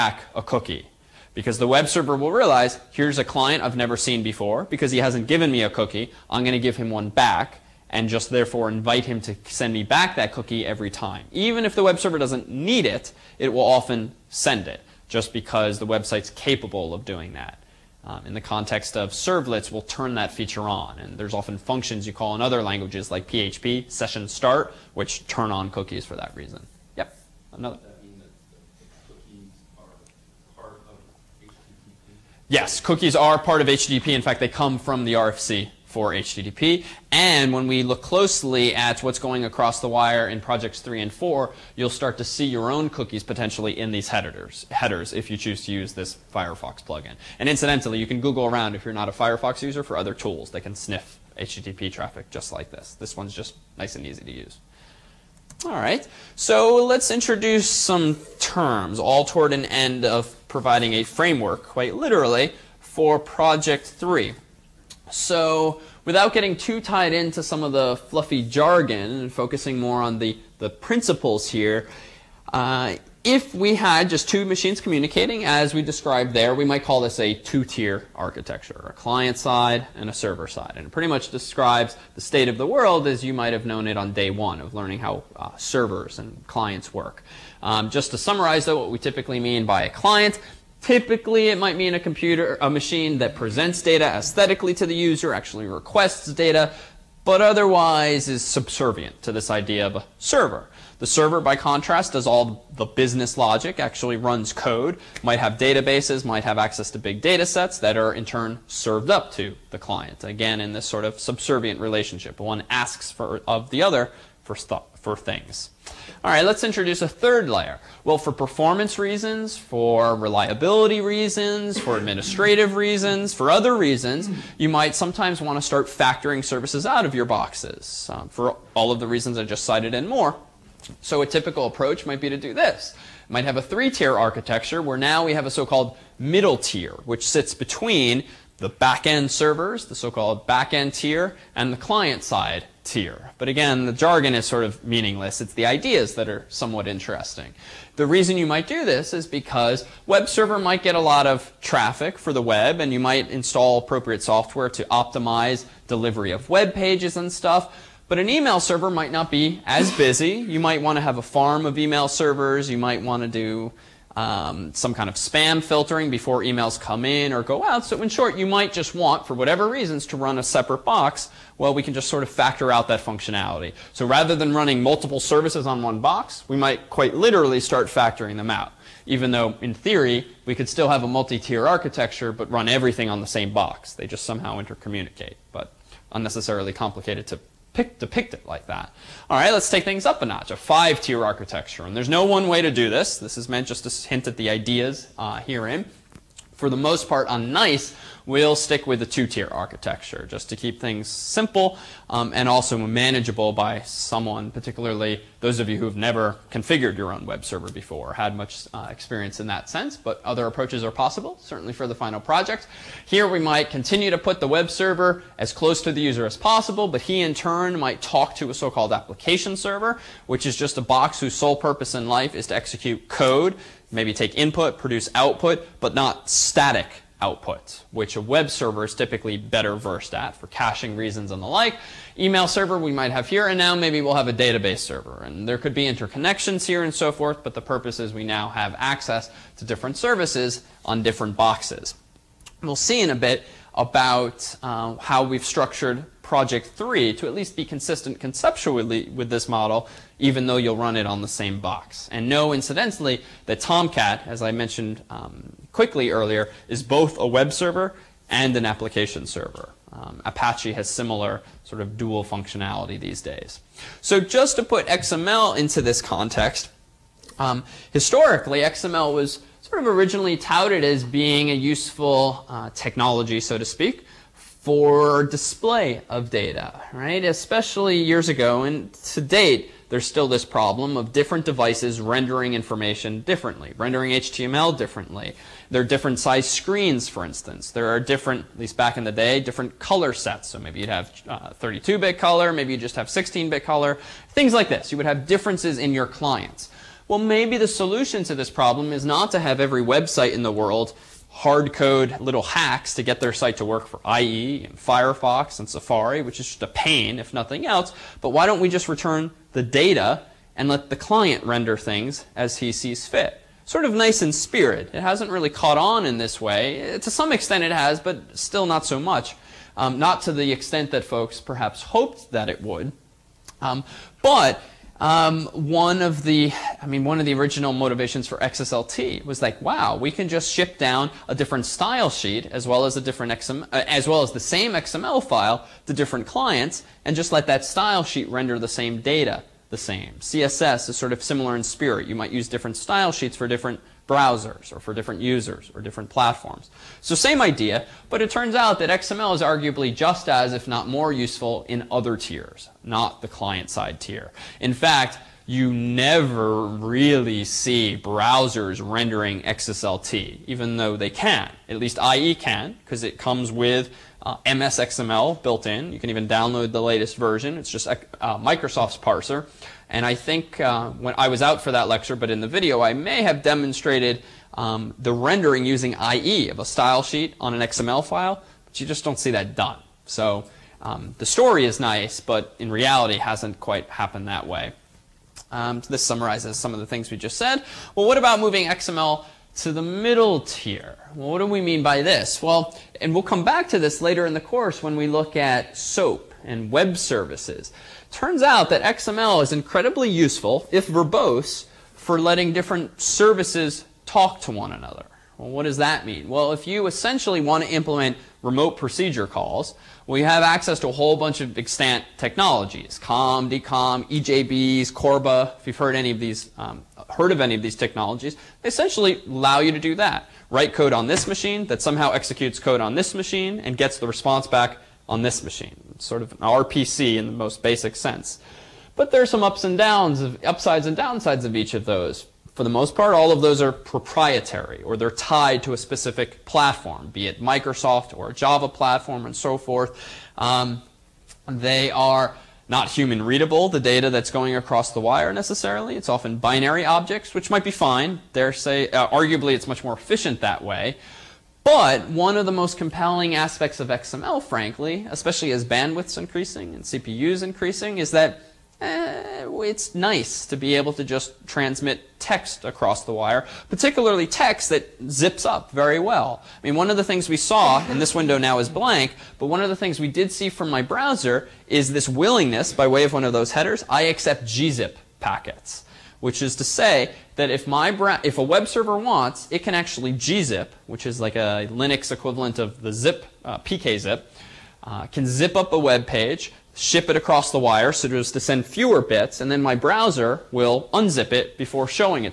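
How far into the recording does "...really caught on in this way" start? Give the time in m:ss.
5:15.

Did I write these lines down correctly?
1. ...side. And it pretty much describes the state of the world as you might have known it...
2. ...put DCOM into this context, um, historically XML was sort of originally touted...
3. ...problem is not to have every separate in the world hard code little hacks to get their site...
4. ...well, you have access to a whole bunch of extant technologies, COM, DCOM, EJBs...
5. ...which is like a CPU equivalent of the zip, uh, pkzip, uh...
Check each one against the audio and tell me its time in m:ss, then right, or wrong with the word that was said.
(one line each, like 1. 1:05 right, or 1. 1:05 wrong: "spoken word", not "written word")
1. 1:20 right
2. 4:24 wrong: "XML", not "DCOM"
3. 4:58 wrong: "website", not "separate"
4. 6:50 right
5. 8:00 wrong: "Linux", not "CPU".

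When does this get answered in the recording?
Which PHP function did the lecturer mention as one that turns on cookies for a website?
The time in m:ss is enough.
0:23.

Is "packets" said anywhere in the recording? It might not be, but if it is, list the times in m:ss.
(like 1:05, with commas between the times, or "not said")
7:55.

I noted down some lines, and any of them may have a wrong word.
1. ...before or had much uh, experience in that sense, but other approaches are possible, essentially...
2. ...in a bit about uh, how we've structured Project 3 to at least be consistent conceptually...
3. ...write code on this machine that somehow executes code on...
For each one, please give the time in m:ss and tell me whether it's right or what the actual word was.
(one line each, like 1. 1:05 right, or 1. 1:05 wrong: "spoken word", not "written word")
1. 3:27 wrong: "certainly", not "essentially"
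2. 4:03 right
3. 7:00 right.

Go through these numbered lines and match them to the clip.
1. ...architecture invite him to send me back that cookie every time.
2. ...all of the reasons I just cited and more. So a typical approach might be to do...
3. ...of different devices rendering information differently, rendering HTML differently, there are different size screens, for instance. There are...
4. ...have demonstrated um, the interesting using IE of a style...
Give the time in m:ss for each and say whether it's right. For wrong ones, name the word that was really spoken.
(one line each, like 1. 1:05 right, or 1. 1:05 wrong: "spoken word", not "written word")
1. 0:08 wrong: "therefore", not "architecture"
2. 2:08 right
3. 4:40 right
4. 6:13 wrong: "rendering", not "interesting".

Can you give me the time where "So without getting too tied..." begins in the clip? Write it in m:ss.
1:05.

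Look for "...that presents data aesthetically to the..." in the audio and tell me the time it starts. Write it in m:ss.
1:33.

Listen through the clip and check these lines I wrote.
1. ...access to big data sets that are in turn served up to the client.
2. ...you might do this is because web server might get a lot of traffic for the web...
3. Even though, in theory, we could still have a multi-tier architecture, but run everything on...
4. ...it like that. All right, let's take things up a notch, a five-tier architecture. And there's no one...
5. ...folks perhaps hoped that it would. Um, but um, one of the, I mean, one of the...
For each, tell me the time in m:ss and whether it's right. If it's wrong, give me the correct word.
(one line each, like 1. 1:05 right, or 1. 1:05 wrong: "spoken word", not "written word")
1. 1:46 right
2. 2:28 right
3. 2:59 right
4. 3:08 right
5. 5:21 right.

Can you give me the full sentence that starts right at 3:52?
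Email server we might have here, and now maybe we'll have a database server.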